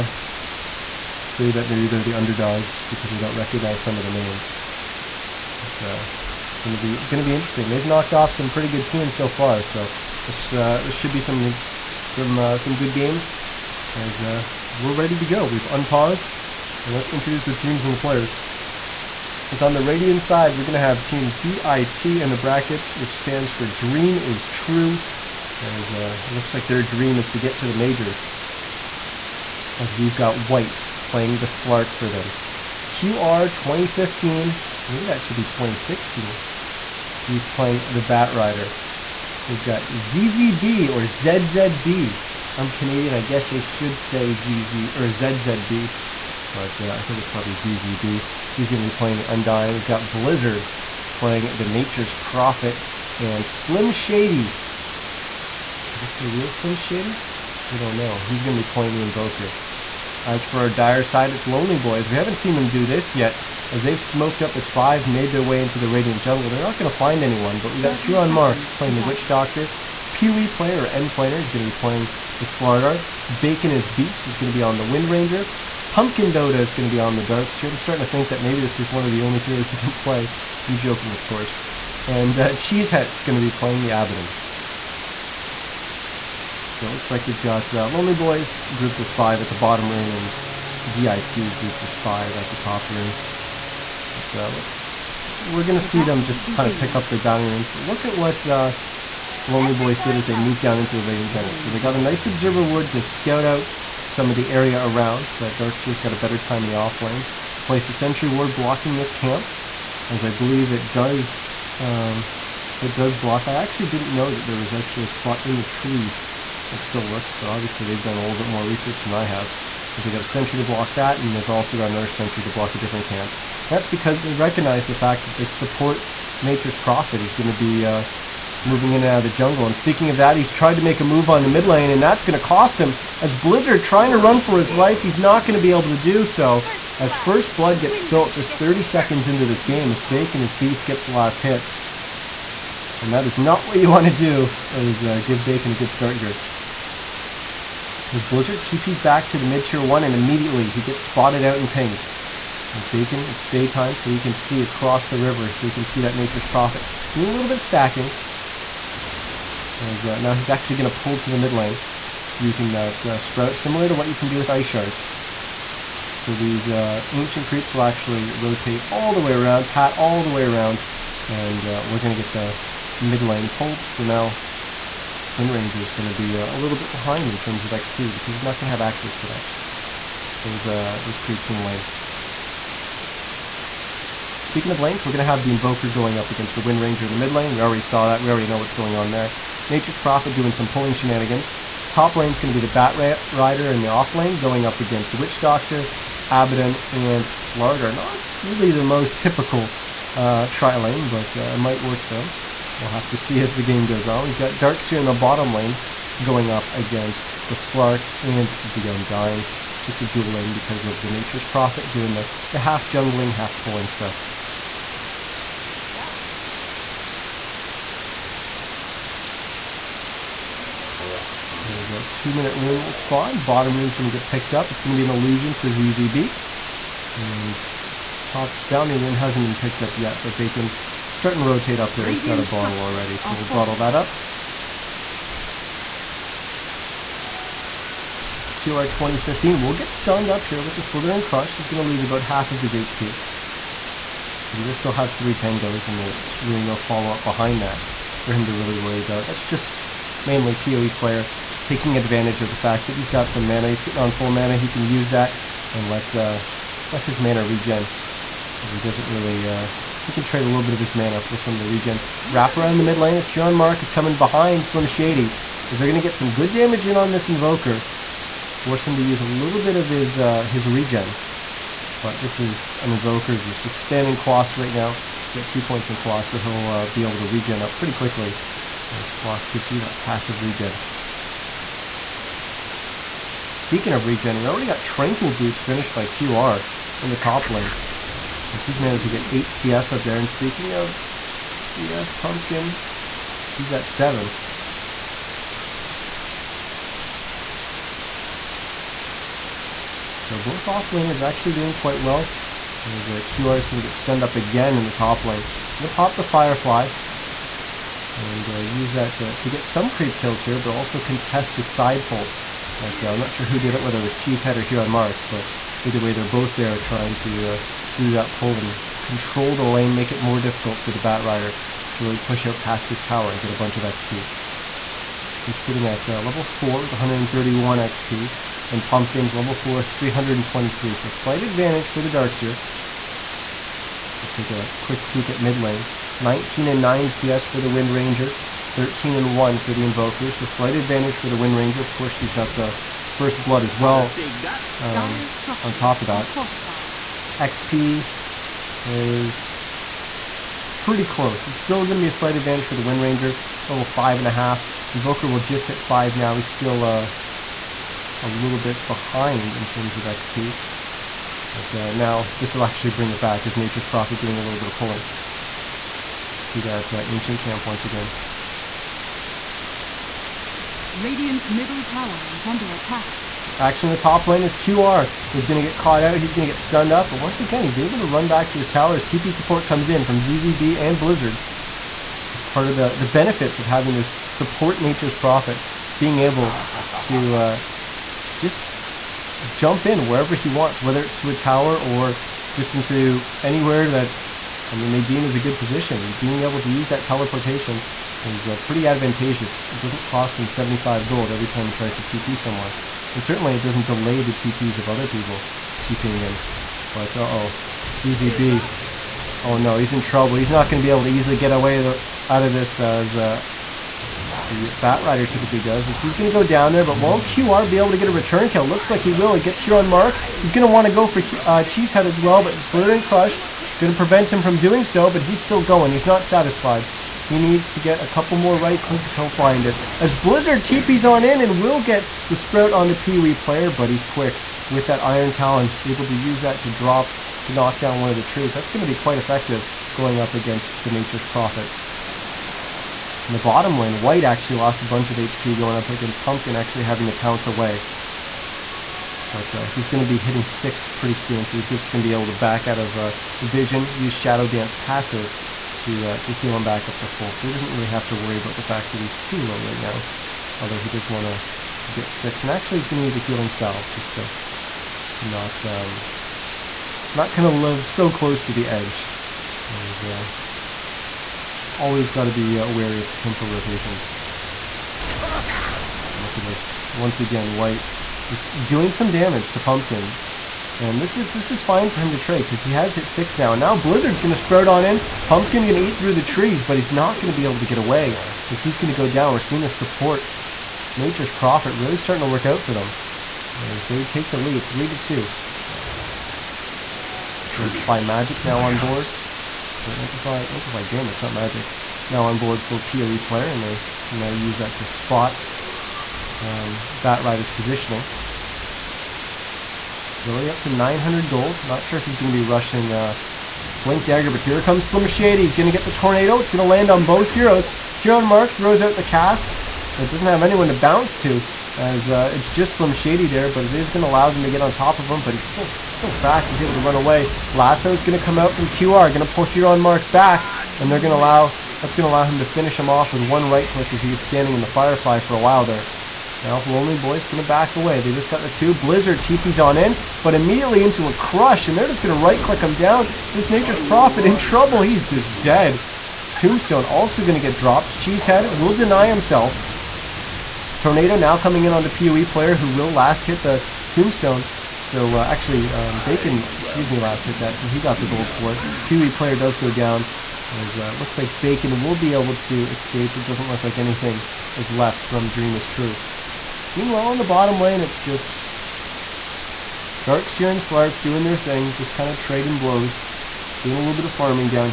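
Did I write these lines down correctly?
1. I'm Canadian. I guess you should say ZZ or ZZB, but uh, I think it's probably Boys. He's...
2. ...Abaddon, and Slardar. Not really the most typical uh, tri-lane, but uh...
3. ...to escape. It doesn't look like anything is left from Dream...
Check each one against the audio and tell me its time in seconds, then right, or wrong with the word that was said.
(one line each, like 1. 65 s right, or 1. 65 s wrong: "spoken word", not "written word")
1. 42 s wrong: "ZZB", not "Boys"
2. 196 s right
3. 562 s right.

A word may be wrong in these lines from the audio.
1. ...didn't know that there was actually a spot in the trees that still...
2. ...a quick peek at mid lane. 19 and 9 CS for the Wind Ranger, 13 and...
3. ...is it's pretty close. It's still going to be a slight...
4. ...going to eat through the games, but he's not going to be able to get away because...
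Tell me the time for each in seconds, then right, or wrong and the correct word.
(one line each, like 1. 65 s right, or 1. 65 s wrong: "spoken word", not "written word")
1. 113 s right
2. 334 s right
3. 348 s right
4. 485 s wrong: "trees", not "games".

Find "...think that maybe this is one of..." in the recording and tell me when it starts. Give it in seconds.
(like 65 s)
78 s.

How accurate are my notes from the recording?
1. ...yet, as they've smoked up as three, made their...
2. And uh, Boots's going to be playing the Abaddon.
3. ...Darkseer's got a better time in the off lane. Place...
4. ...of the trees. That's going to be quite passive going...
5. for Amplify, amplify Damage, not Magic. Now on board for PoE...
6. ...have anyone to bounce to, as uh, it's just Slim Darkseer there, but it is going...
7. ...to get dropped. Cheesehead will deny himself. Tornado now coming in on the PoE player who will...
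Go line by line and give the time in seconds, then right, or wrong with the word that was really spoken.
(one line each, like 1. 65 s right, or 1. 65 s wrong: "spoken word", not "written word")
1. 63 s wrong: "five", not "three"
2. 82 s wrong: "Cheesehead", not "Boots"
3. 105 s right
4. 438 s wrong: "effective", not "passive"
5. 499 s right
6. 520 s wrong: "Shady", not "Darkseer"
7. 547 s right.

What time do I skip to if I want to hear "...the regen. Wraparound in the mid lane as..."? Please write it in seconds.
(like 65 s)
261 s.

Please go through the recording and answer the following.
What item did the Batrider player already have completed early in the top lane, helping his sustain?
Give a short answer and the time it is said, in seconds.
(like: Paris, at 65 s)
Tranquil Boots, at 284 s.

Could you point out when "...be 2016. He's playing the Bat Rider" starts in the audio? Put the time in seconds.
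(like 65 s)
35 s.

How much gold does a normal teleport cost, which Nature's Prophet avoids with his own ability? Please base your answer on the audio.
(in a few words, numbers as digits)
75.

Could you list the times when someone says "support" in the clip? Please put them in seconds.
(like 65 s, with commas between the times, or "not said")
125 s, 379 s, 384 s, 489 s.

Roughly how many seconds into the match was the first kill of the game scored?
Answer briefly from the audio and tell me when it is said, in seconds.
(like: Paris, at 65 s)
30, at 138 s.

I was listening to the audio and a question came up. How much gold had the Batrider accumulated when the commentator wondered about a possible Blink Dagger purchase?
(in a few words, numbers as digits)
900.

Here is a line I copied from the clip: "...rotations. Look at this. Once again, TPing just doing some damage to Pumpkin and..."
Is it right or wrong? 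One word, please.
wrong.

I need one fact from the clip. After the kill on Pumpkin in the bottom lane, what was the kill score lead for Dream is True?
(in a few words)
3 to 2.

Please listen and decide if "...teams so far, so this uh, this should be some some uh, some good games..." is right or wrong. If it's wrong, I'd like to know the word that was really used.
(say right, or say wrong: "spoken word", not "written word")
right.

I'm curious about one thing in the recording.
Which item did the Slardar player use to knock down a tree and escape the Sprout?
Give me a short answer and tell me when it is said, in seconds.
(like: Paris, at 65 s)
Iron Talon, at 435 s.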